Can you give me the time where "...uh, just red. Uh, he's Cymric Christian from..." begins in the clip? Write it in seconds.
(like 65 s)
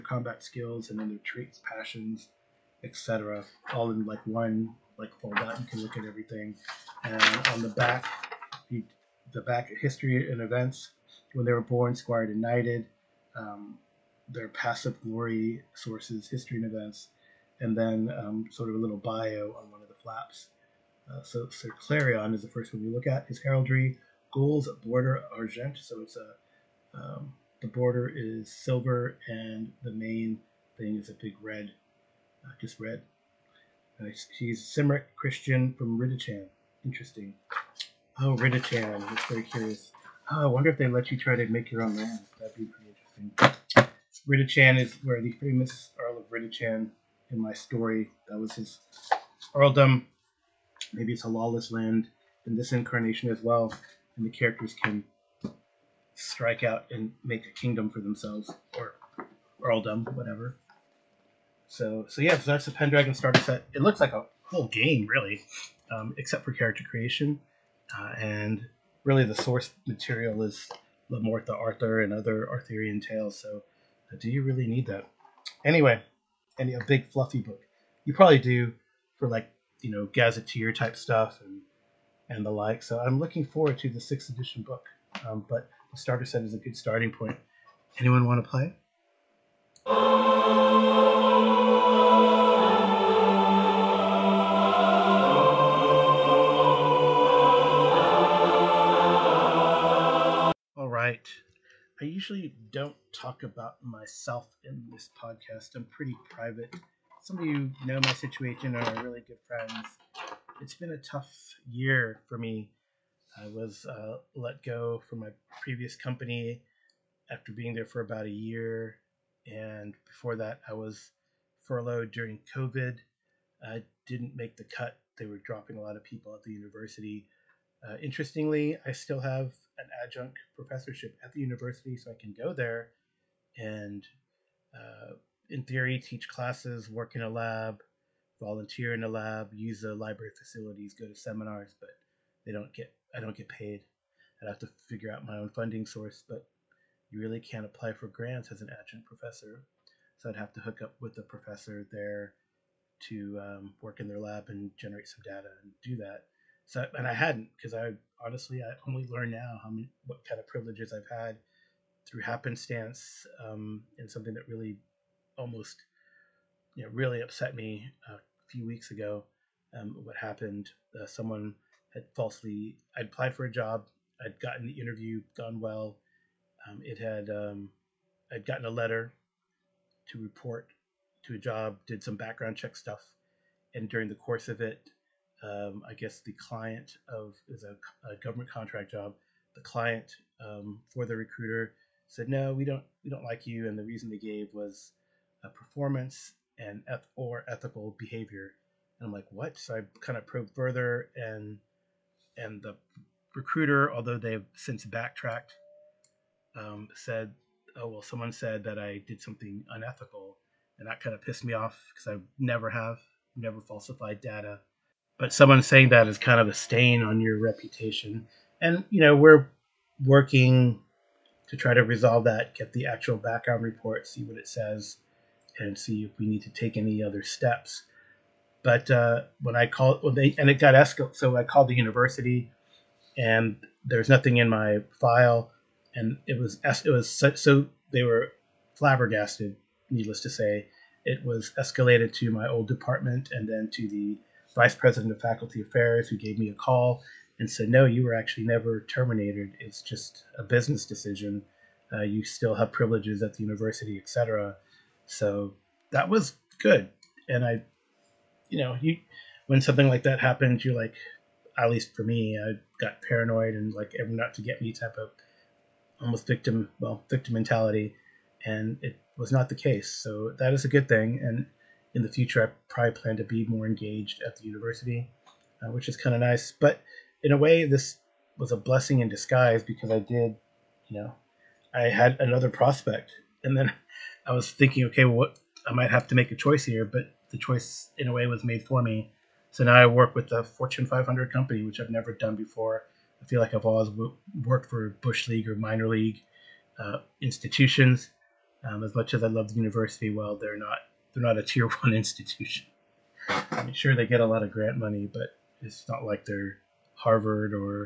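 32 s.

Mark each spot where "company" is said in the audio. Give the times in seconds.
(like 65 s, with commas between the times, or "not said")
115 s, 291 s.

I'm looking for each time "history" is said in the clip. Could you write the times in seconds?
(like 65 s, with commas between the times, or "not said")
9 s, 16 s.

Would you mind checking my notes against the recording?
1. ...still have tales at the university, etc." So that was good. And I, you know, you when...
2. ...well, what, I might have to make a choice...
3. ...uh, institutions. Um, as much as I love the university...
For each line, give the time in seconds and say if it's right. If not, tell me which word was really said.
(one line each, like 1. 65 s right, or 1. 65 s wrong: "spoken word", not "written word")
1. 252 s wrong: "privileges", not "tales"
2. 285 s right
3. 296 s right.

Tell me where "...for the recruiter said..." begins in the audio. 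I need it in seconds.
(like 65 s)
190 s.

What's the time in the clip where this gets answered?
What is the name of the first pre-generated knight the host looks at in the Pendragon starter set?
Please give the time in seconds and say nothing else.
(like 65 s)
21 s.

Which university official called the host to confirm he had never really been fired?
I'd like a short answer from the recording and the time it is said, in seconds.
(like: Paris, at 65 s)
vice president of faculty affairs, at 244 s.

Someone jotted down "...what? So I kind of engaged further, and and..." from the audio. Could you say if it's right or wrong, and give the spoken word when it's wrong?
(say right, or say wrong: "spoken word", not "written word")
wrong: "probed", not "engaged".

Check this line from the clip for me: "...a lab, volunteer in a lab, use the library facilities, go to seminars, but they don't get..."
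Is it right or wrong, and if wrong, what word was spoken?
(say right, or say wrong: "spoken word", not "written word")
right.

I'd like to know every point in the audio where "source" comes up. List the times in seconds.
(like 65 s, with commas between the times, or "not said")
15 s, 69 s, 145 s.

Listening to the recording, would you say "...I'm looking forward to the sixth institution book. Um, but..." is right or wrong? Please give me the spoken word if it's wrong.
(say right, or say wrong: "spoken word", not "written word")
wrong: "edition", not "institution".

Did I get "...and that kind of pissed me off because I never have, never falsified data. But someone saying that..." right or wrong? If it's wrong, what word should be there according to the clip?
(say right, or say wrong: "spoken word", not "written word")
right.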